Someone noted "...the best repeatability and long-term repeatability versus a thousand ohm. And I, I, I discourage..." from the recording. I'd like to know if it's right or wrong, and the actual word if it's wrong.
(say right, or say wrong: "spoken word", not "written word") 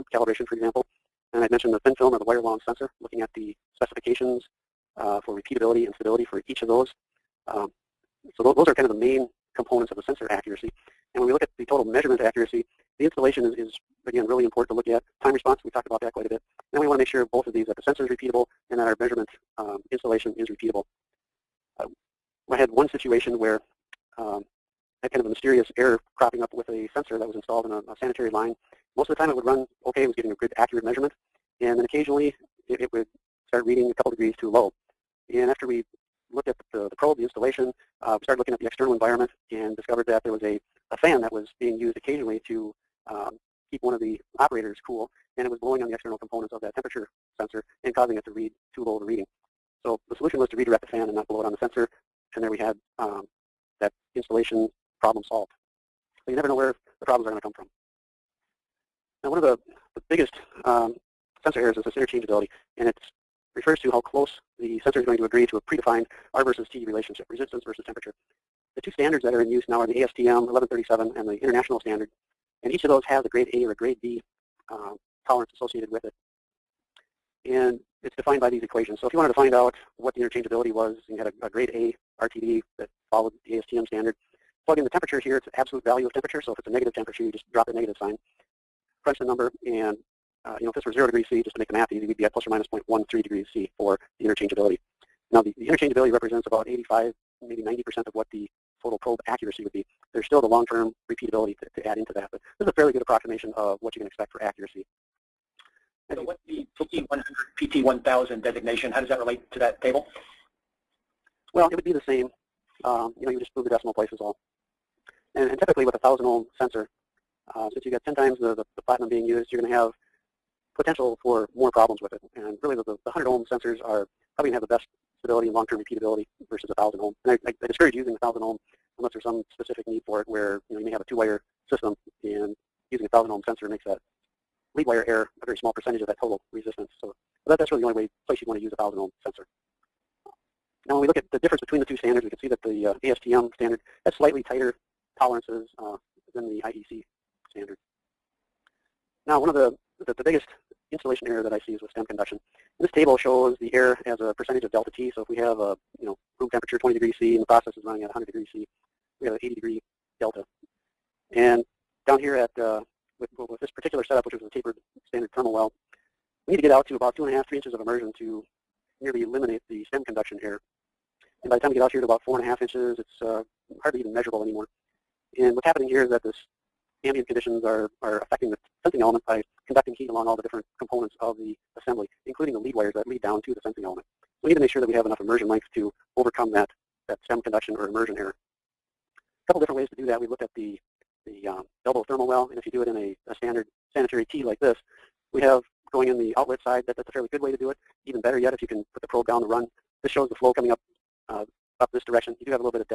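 wrong: "stability", not "repeatability".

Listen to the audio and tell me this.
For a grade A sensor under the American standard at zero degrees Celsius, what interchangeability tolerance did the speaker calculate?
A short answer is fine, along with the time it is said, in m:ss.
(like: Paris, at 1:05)
±0.13 degrees C, at 1:32.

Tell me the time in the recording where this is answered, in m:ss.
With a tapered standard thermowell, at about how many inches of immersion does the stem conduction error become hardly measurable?
2:52.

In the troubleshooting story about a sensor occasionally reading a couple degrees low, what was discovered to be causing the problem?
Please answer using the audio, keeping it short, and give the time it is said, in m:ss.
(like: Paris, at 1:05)
A fan, at 0:40.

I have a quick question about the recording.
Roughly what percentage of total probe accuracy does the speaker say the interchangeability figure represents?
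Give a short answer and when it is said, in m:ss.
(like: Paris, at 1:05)
85 to 90%, at 1:36.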